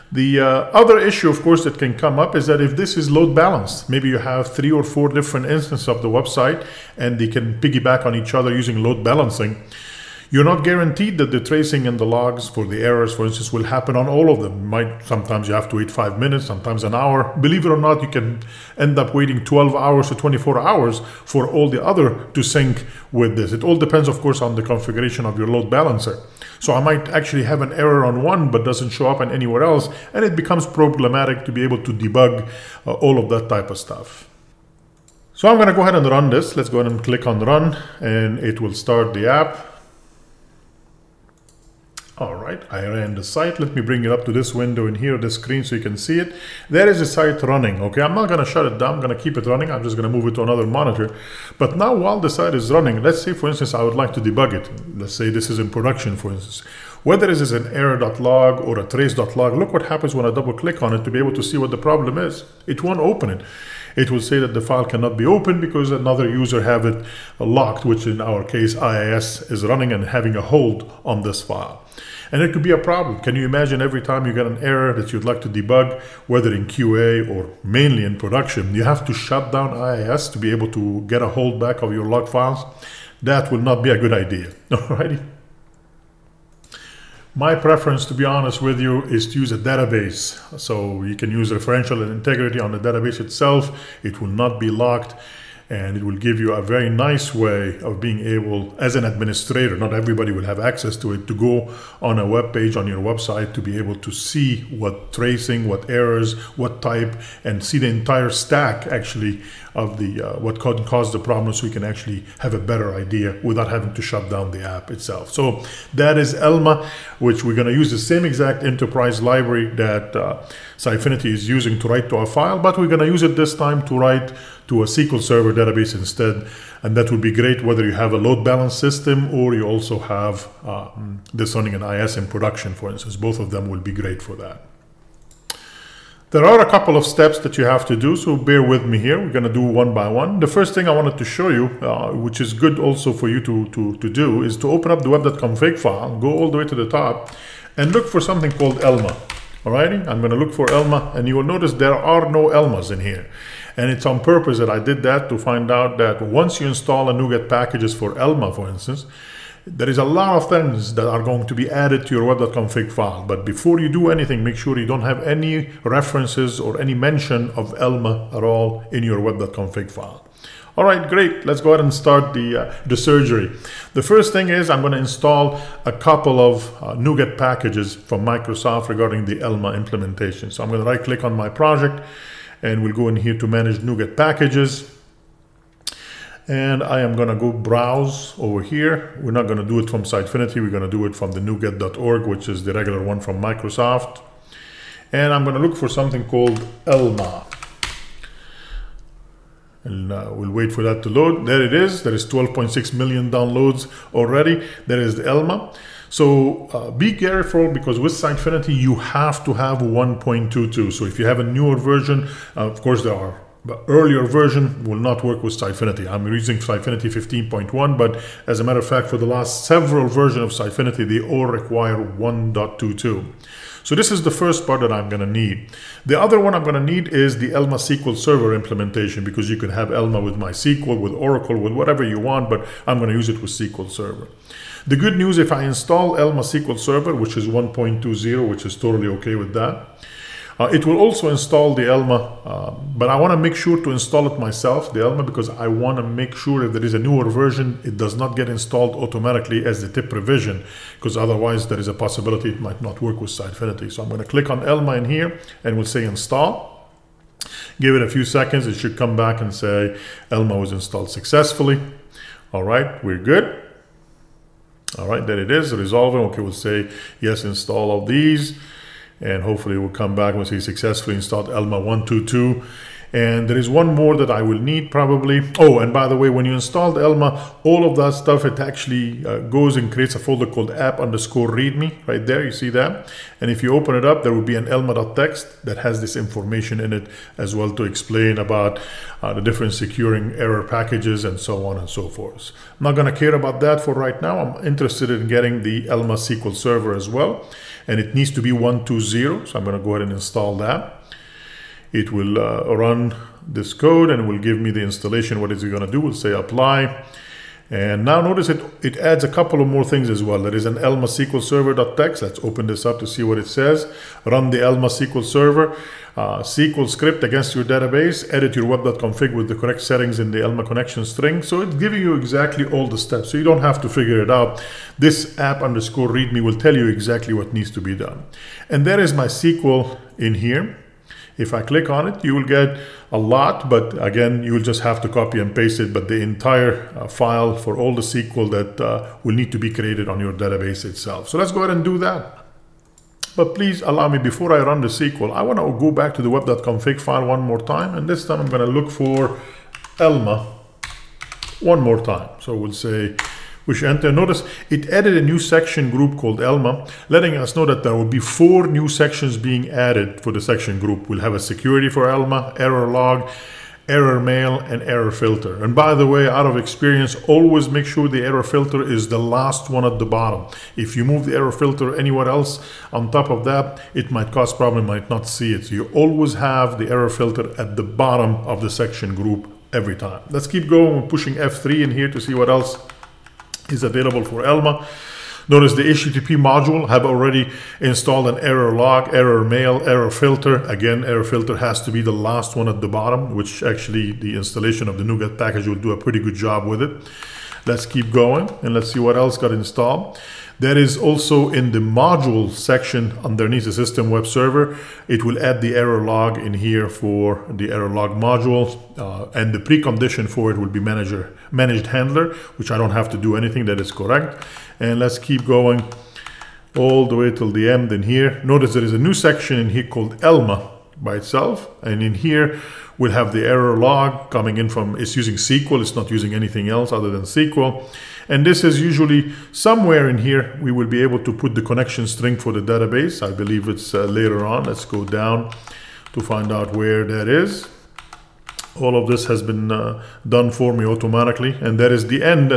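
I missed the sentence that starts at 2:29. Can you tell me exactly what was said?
Alrighty, I'm going to look for Elmah, and you will notice there are no Elmahs in here.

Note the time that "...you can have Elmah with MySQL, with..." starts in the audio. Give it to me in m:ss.
3:49.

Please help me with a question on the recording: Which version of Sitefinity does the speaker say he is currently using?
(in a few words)
15.1.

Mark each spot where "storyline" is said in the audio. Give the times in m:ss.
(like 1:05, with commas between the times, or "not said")
not said.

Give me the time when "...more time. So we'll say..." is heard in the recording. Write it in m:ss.
5:51.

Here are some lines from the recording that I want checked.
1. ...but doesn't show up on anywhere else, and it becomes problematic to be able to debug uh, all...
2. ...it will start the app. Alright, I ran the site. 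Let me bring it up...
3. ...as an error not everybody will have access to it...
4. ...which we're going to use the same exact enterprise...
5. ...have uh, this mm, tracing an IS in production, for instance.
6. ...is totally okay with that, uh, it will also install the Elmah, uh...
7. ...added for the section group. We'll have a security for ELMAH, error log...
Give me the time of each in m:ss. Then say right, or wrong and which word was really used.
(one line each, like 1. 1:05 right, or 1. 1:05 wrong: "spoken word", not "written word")
1. 0:28 right
2. 0:38 right
3. 1:38 wrong: "administrator", not "error"
4. 1:57 right
5. 2:09 wrong: "running", not "tracing"
6. 3:58 right
7. 5:59 right.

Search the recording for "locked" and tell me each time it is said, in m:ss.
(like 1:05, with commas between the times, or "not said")
1:07, 1:34.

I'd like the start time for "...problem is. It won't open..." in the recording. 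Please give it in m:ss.
1:01.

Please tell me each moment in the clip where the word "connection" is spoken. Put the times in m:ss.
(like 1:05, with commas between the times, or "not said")
5:20, 7:11.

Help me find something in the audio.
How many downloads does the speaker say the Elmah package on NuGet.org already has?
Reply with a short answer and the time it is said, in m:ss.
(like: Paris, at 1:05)
12.6 million, at 3:22.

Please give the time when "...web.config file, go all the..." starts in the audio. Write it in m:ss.
2:25.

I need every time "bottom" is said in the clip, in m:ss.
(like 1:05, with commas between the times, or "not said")
6:10, 6:17, 6:32.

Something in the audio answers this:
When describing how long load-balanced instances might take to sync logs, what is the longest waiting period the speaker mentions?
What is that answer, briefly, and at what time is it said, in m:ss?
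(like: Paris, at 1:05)
24 hours, at 0:20.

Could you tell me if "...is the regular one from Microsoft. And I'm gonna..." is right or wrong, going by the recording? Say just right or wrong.
right.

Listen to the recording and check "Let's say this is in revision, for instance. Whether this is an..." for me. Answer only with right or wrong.
wrong.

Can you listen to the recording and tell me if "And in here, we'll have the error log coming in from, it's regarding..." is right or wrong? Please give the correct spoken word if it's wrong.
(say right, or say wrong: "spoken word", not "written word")
wrong: "using", not "regarding".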